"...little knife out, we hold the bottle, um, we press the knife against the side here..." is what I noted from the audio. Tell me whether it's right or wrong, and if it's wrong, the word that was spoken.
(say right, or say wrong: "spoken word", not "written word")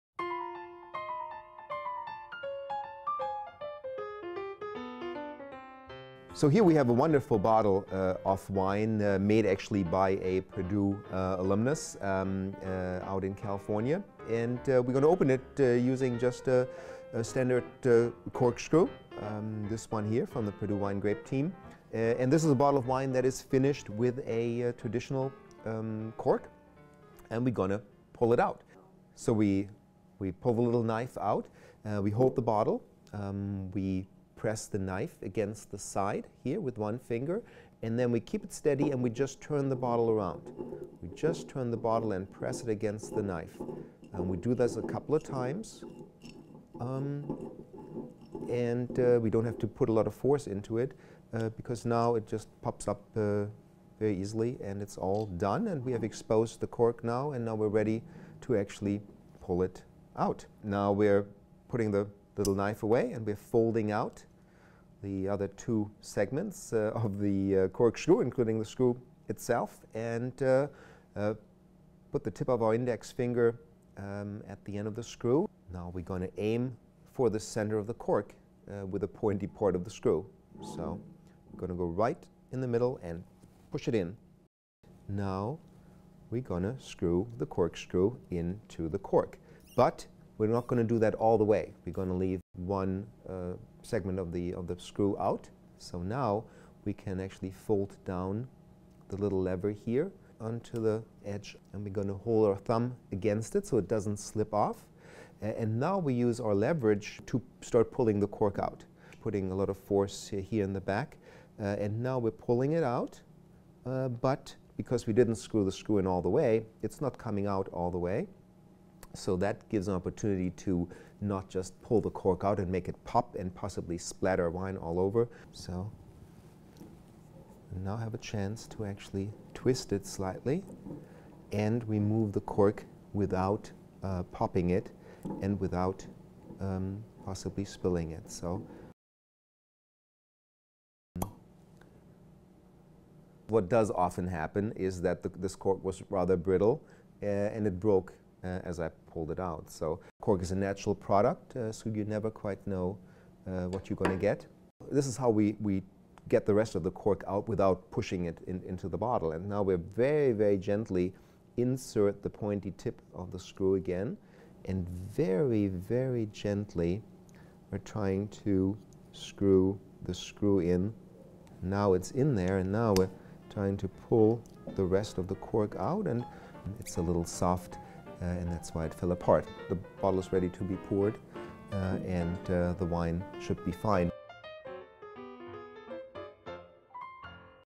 right.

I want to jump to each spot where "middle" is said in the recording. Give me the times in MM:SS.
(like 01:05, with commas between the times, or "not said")
01:22.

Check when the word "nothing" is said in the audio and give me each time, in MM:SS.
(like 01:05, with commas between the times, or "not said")
not said.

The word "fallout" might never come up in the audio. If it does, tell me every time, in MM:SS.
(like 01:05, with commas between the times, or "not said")
not said.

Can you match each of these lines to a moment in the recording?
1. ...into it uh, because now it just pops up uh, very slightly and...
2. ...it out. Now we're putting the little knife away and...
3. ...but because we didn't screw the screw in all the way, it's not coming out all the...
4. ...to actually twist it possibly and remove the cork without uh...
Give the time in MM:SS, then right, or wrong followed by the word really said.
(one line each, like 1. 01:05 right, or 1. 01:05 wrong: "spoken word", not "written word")
1. 00:50 wrong: "easily", not "slightly"
2. 00:59 right
3. 01:54 right
4. 02:08 wrong: "slightly", not "possibly".